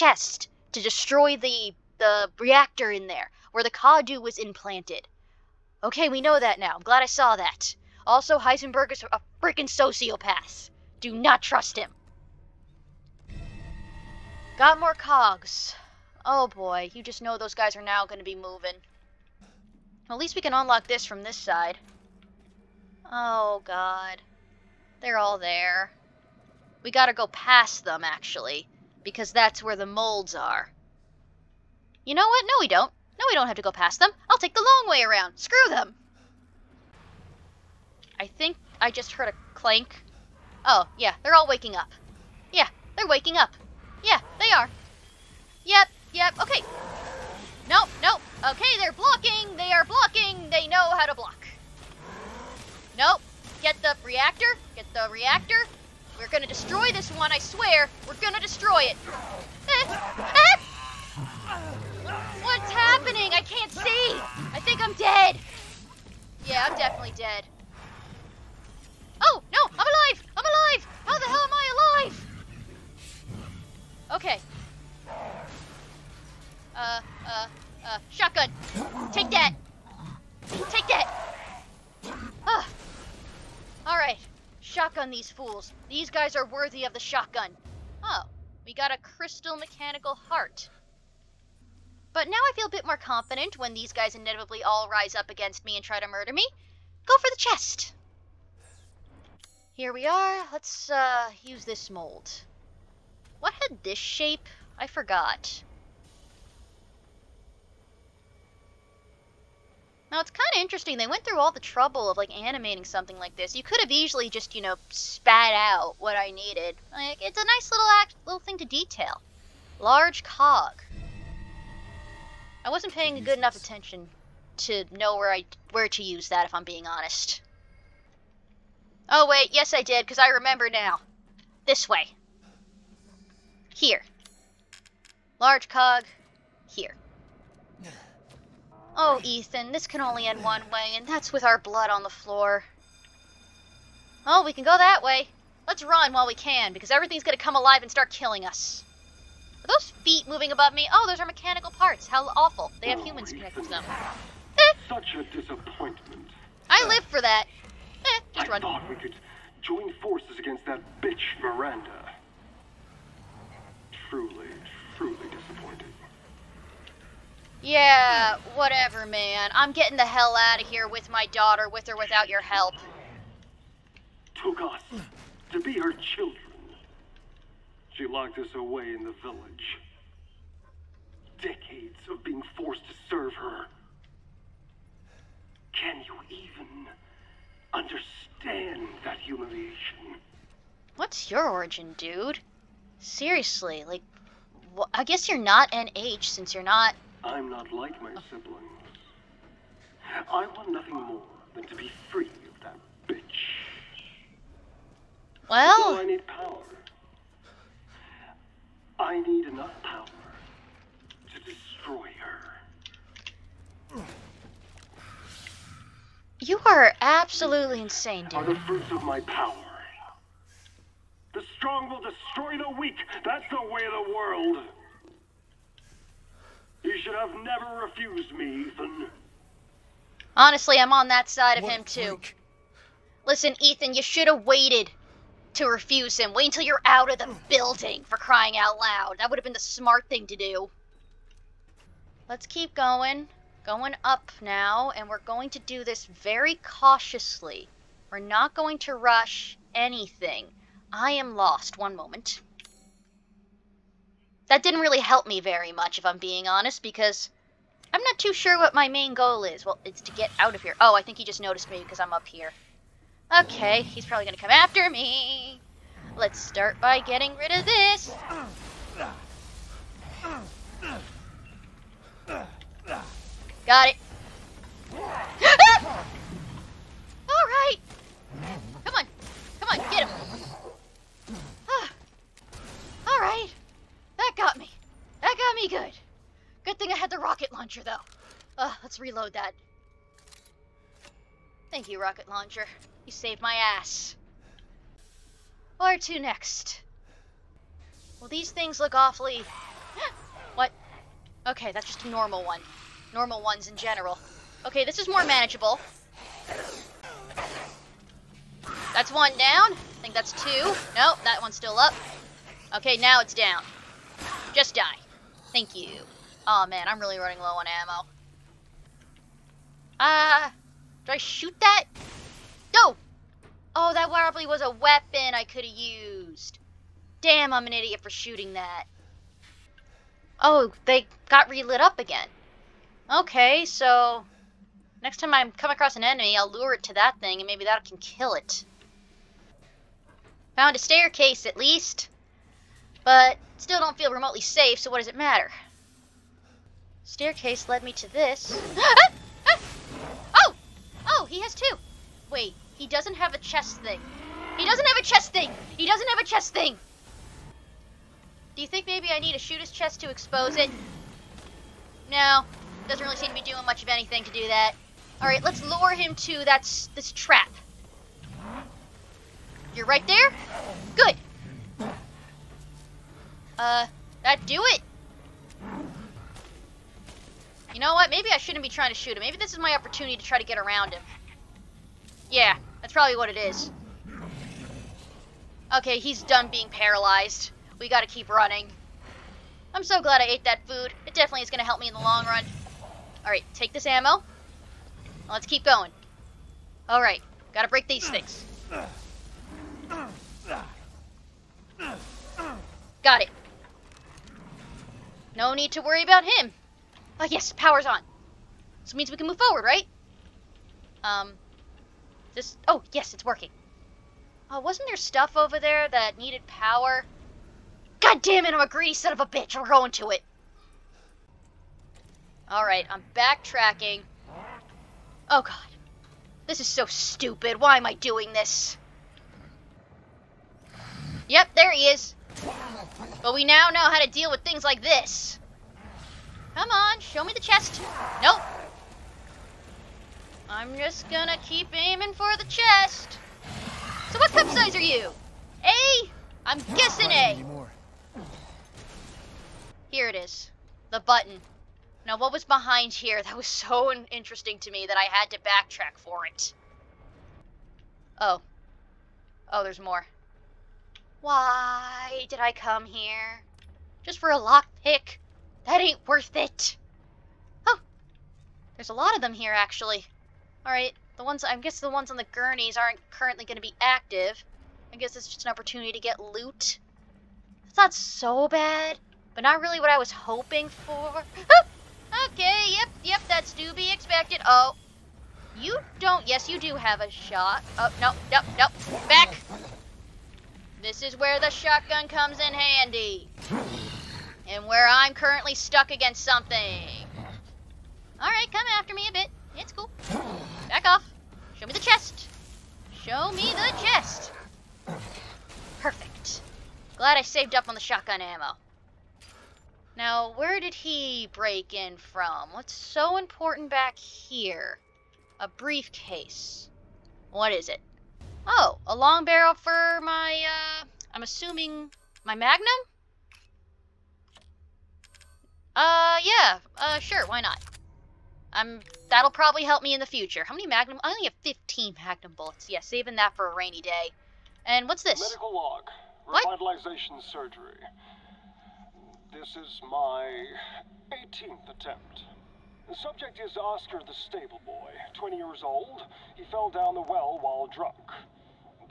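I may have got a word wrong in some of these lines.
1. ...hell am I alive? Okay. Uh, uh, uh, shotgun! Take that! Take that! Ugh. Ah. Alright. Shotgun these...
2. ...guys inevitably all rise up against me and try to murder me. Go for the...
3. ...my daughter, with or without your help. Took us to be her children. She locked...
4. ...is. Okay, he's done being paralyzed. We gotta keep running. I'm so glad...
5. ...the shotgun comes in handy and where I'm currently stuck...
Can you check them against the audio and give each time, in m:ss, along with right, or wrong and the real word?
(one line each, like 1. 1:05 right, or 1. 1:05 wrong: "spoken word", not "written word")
1. 1:11 right
2. 1:33 right
3. 2:51 right
4. 6:23 right
5. 8:11 right.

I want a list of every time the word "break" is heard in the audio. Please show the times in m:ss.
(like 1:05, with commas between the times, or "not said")
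6:37, 8:31.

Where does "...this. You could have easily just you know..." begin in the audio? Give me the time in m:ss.
1:53.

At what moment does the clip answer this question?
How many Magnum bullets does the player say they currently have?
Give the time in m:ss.
8:51.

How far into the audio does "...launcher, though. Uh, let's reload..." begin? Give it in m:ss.
4:47.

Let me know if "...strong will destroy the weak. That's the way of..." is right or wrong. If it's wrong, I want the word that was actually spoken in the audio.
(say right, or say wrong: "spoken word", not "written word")
right.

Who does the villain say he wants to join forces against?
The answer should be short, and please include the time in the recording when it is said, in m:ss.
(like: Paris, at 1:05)
Miranda, at 2:41.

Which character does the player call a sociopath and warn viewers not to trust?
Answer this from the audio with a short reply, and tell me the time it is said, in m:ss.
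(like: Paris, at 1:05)
Heisenberg, at 0:08.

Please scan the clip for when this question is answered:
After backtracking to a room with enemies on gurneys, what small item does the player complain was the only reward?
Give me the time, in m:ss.
7:44.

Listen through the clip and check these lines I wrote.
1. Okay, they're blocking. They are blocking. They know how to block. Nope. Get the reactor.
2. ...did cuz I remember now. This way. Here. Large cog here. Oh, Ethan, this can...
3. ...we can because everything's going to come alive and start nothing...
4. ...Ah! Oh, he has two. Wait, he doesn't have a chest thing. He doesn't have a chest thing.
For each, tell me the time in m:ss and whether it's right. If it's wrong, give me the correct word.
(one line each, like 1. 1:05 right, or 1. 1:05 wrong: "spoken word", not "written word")
1. 0:48 right
2. 2:09 right
3. 2:26 wrong: "killing", not "nothing"
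4. 5:48 right.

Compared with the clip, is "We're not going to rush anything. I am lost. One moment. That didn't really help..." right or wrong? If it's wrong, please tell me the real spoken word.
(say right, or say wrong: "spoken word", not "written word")
right.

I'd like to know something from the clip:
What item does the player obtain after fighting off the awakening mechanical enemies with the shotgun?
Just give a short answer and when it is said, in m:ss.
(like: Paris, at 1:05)
Crystal mechanical heart, at 1:28.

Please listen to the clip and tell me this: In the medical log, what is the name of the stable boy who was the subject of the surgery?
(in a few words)
Oscar.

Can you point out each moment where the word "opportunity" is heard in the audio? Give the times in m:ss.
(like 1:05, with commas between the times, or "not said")
6:19, 7:55.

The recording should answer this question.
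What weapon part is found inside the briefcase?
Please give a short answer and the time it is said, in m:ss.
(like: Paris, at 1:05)
A long barrel, at 8:38.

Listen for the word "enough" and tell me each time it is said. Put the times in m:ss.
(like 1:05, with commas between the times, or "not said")
2:03, 3:29.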